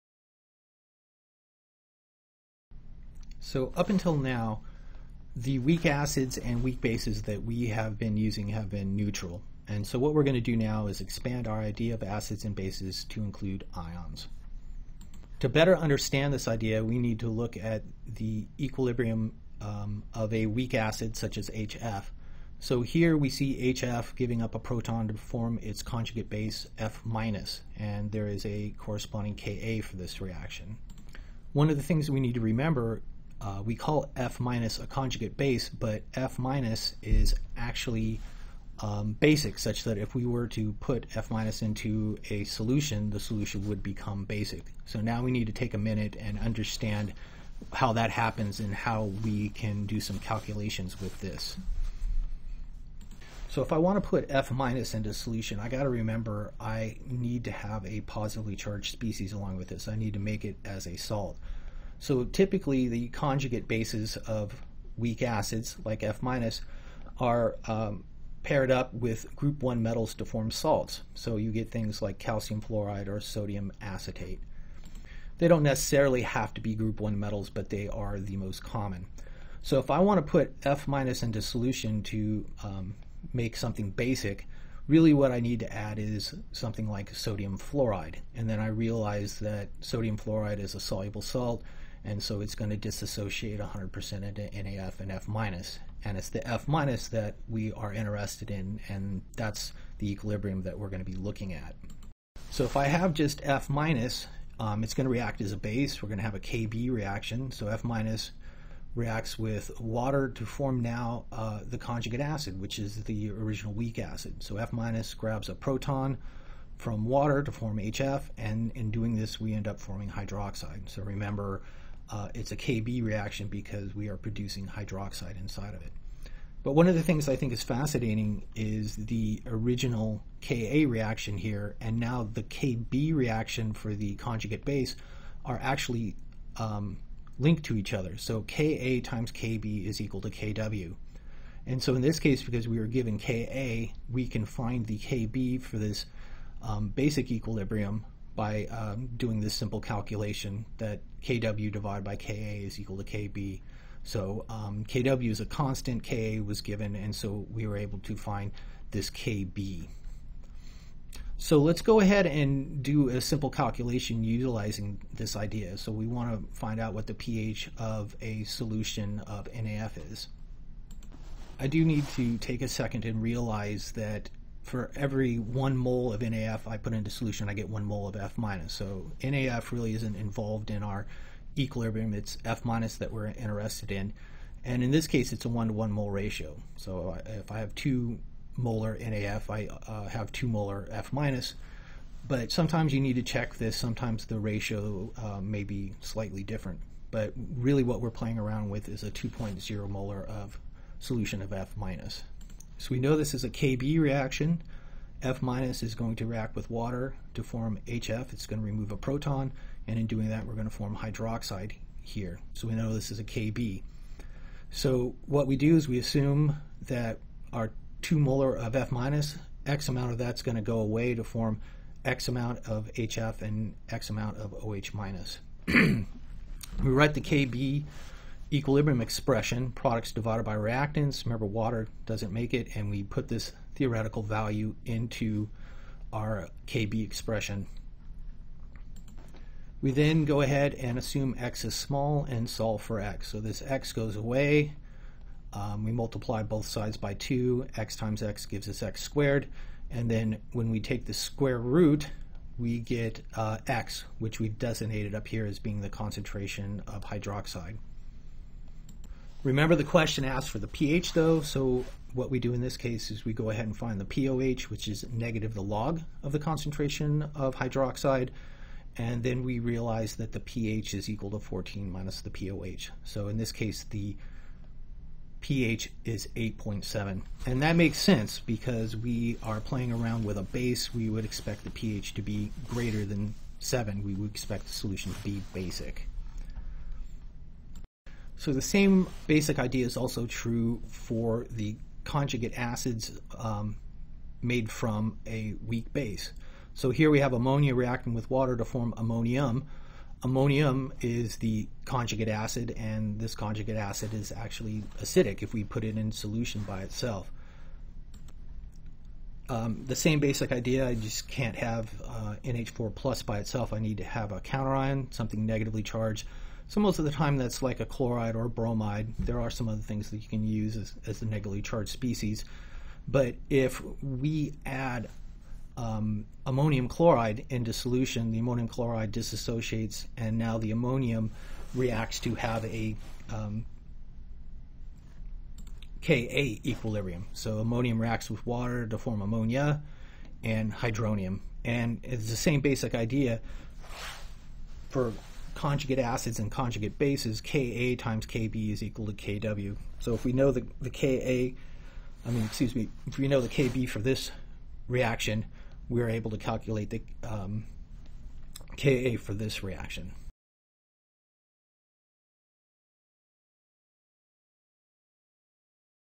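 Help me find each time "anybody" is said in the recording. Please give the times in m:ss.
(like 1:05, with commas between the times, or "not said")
not said.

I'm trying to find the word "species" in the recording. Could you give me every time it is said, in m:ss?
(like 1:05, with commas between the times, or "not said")
0:58, 5:21.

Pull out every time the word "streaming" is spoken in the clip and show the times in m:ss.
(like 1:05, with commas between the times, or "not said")
not said.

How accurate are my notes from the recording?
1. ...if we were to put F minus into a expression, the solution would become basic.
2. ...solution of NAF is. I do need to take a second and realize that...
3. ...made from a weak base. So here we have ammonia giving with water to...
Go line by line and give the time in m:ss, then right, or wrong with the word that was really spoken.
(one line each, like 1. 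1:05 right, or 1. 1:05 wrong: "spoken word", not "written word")
1. 0:39 wrong: "solution", not "expression"
2. 2:48 right
3. 4:54 wrong: "reacting", not "giving".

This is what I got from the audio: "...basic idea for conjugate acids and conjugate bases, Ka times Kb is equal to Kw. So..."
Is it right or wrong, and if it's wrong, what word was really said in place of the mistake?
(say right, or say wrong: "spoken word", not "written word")
right.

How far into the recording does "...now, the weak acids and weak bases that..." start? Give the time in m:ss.
0:04.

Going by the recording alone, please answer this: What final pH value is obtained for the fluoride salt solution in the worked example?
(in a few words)
8.7.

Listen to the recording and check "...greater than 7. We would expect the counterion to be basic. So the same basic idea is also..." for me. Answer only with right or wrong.
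wrong.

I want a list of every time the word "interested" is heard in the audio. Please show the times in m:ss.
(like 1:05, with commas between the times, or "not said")
1:37, 3:03.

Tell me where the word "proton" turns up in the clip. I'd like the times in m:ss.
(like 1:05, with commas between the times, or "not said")
0:24, 1:55, 3:28.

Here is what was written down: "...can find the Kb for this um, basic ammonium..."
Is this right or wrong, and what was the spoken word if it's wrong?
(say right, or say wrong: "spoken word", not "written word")
wrong: "equilibrium", not "ammonium".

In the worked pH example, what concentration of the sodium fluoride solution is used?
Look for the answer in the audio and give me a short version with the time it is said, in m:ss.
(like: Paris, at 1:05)
2.0 molar, at 3:19.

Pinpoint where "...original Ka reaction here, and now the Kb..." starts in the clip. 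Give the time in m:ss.
2:09.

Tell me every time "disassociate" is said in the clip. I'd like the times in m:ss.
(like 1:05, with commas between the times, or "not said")
1:32, 5:29.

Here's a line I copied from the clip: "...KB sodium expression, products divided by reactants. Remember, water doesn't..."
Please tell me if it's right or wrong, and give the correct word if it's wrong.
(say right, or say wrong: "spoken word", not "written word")
wrong: "equilibrium", not "sodium".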